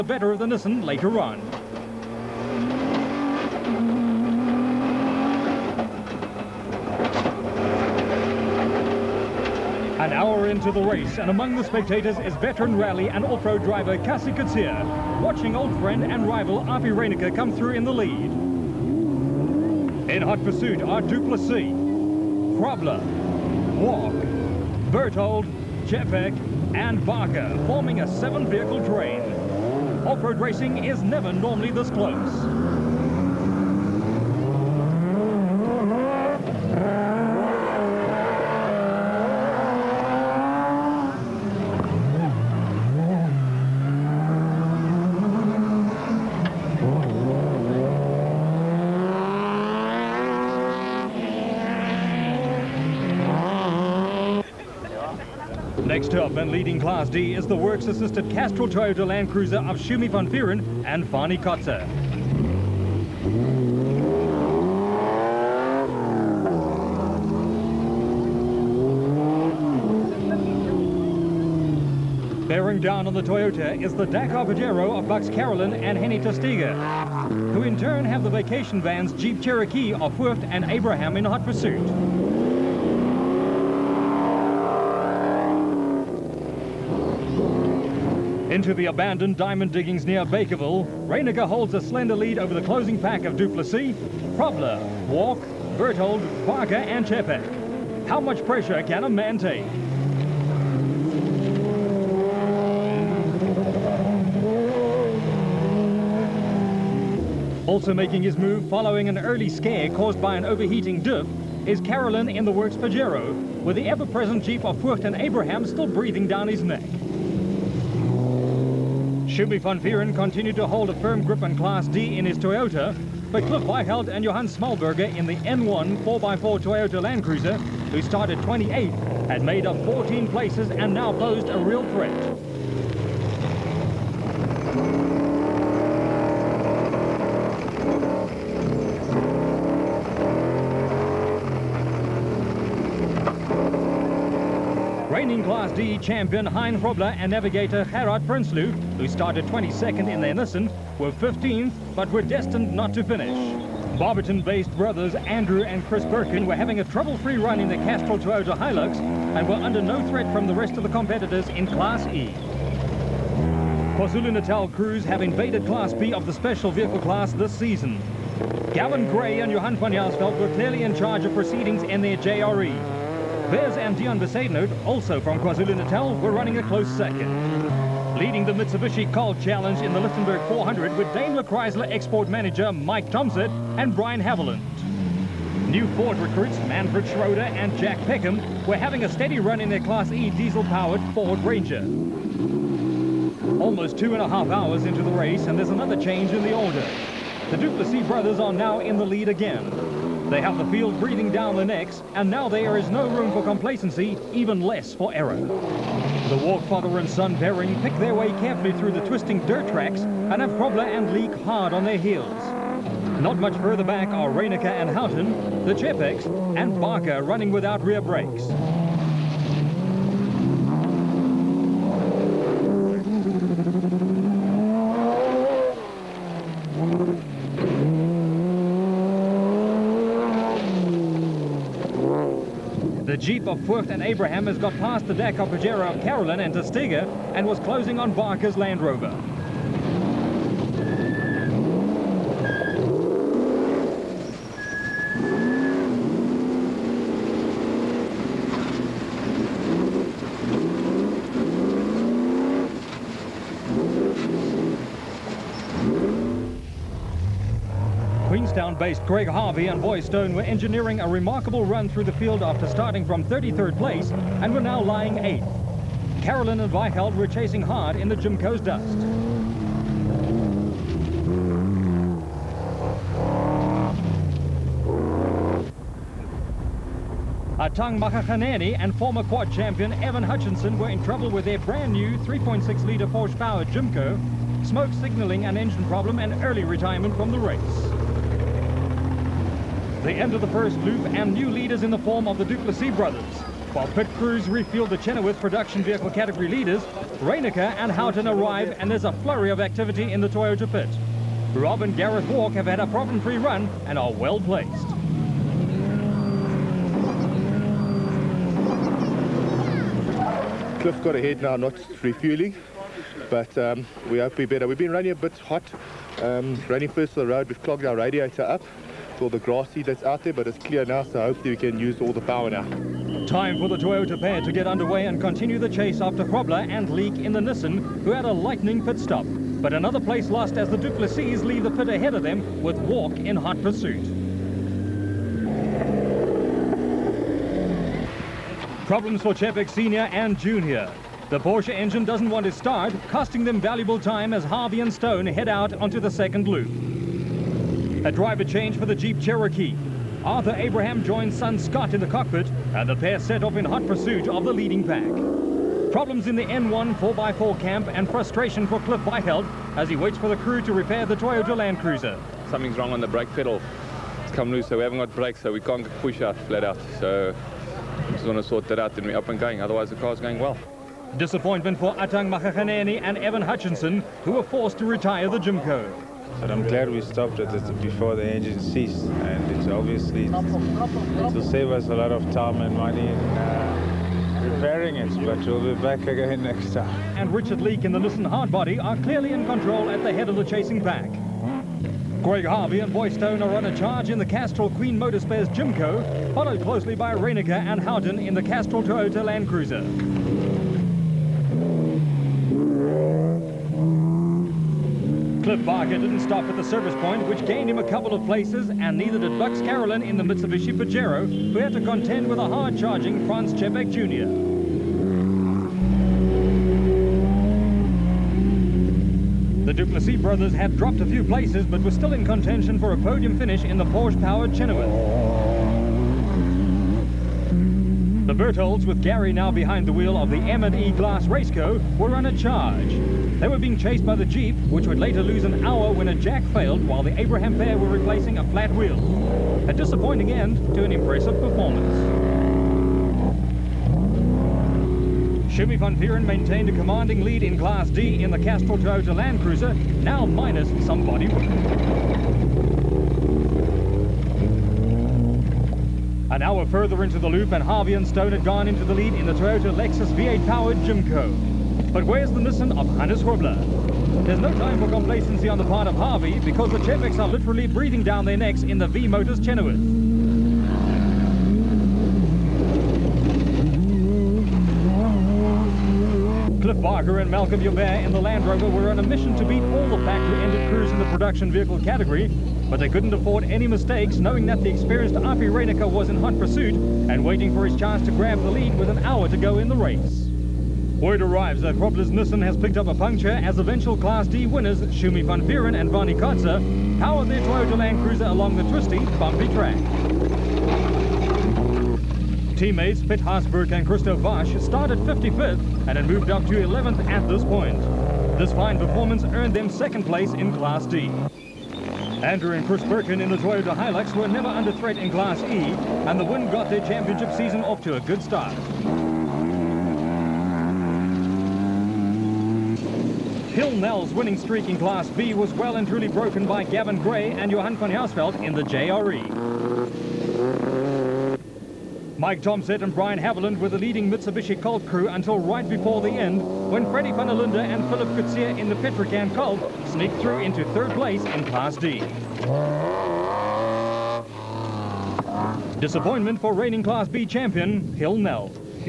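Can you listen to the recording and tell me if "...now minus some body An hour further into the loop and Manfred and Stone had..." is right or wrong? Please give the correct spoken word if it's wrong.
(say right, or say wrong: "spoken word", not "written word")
wrong: "Harvey", not "Manfred".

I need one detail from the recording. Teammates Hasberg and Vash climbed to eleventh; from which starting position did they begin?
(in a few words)
55th.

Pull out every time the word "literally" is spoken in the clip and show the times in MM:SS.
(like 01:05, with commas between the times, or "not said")
07:47.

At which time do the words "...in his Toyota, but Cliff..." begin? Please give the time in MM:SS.
02:02.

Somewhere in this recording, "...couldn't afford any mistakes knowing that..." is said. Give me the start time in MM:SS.
08:02.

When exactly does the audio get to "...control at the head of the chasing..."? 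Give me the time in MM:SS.
06:29.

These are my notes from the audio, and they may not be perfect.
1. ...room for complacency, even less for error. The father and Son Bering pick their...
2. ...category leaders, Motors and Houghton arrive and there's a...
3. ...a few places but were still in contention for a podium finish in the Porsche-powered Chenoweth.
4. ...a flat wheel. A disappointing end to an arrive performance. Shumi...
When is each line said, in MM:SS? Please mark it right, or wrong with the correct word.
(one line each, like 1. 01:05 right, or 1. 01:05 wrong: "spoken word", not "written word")
1. 03:23 right
2. 04:56 wrong: "Reinecker", not "Motors"
3. 07:01 right
4. 07:18 wrong: "impressive", not "arrive".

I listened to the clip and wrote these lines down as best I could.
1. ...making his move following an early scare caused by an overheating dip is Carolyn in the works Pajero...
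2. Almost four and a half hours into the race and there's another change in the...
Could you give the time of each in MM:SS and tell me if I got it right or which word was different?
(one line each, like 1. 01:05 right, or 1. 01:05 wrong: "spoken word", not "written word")
1. 01:47 right
2. 03:13 wrong: "two", not "four".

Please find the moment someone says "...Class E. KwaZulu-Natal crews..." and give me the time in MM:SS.
02:41.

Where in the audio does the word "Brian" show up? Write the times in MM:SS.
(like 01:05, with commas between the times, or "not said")
03:03, 08:52.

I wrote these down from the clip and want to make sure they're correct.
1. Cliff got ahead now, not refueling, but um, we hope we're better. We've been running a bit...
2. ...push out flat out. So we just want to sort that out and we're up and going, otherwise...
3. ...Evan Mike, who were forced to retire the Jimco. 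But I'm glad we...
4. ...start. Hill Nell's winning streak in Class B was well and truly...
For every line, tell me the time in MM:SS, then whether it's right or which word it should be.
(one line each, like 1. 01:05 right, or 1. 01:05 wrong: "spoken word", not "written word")
1. 05:10 right
2. 06:06 right
3. 06:13 wrong: "Hutchinson", not "Mike"
4. 08:38 right.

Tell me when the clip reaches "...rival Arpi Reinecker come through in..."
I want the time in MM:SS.
00:16.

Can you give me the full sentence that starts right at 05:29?
But another place lost as the Duplessis leave the pit ahead of them with Walk in hot pursuit.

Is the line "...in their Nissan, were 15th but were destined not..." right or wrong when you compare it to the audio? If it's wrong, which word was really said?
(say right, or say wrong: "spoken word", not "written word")
right.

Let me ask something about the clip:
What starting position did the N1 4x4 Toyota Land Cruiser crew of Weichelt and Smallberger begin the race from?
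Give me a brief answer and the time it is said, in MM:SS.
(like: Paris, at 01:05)
28th, at 02:08.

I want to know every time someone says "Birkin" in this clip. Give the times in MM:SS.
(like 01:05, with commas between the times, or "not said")
02:36, 08:32.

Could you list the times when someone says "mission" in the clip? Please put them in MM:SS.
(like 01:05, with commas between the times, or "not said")
07:42, 07:59.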